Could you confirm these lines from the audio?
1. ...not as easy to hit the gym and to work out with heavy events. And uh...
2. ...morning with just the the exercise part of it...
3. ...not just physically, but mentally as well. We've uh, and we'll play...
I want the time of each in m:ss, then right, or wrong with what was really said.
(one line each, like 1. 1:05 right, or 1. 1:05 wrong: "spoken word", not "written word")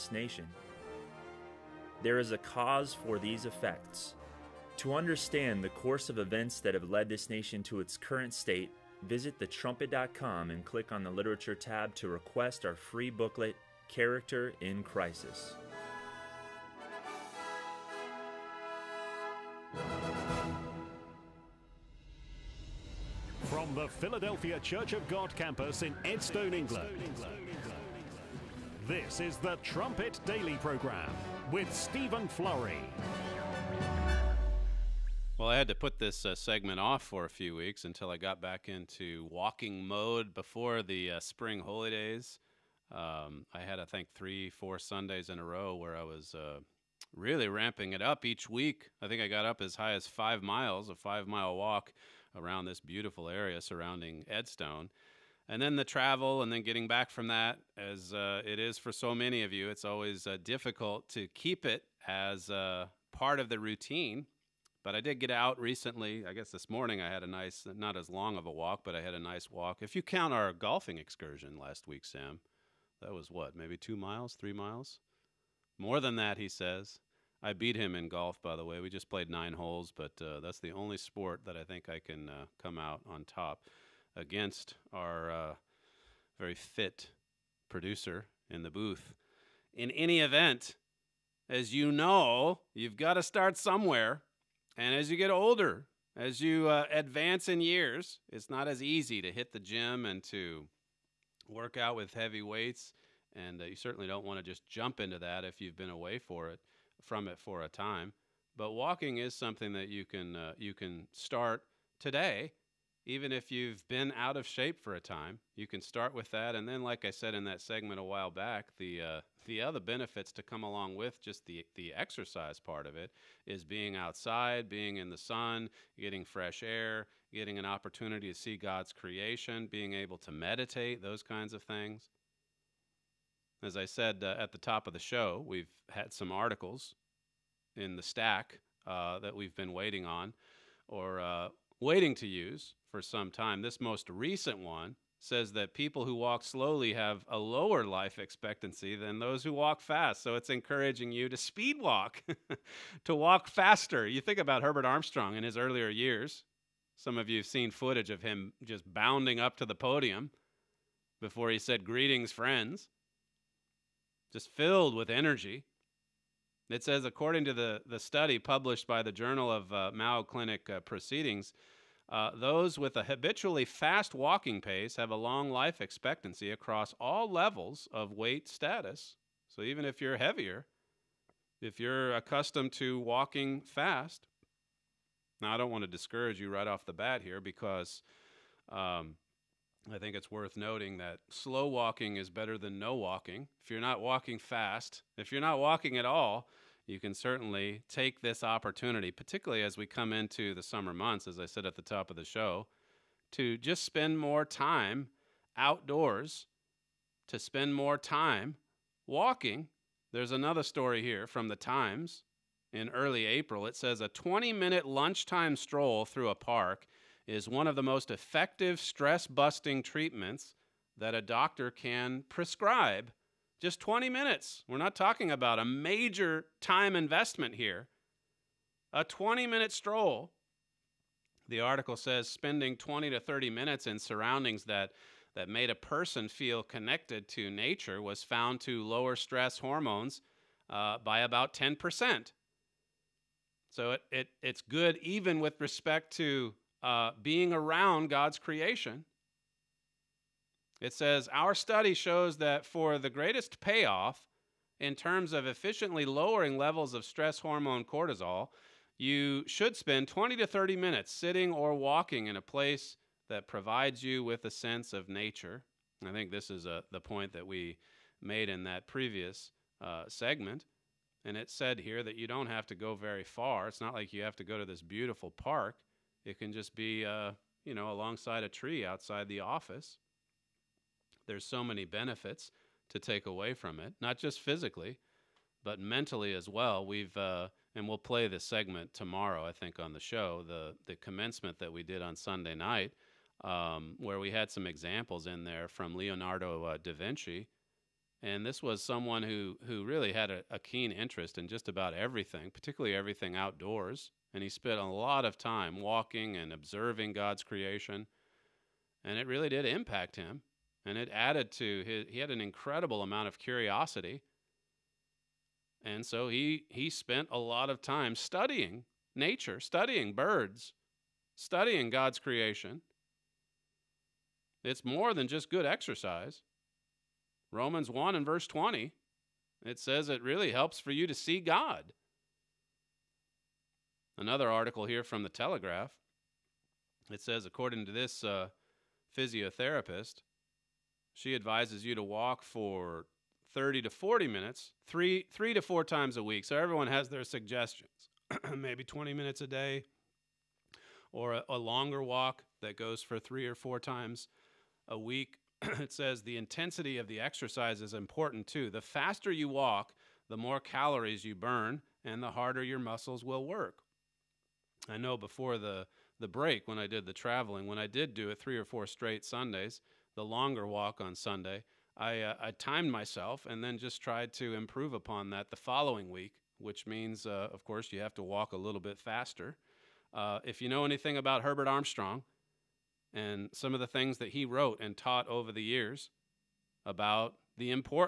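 1. 1:38 wrong: "weights", not "events"
2. 2:00 wrong: "along", not "morning"
3. 4:44 right.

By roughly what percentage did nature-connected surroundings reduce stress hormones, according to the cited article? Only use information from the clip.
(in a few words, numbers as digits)
10%.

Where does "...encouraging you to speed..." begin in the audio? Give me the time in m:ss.
2:30.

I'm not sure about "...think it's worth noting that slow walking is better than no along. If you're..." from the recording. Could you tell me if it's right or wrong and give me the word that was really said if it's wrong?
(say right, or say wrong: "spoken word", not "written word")
wrong: "walking", not "along".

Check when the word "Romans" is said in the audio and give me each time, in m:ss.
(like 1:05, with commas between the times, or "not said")
5:27.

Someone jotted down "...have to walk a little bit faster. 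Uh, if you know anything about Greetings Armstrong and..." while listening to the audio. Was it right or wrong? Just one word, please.
wrong.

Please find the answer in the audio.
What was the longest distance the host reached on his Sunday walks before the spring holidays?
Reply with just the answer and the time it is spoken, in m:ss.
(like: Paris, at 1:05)
5 miles, at 0:50.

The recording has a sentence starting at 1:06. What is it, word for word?
I guess this morning I had a nice, not as long of a walk, but I had a nice walk.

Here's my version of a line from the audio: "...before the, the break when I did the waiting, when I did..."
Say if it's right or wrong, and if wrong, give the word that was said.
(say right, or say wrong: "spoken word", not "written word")
wrong: "traveling", not "waiting".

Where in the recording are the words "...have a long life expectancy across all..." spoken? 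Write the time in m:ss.
2:54.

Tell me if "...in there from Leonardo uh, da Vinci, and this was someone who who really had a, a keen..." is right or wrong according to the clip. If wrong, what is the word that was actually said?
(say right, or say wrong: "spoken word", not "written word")
right.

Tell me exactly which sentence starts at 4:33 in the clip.
It's not like you have to go to this beautiful park.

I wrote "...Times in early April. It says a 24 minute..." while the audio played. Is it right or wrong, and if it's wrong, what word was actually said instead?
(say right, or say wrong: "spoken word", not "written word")
wrong: "20", not "24".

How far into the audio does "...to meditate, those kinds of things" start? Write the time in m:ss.
2:10.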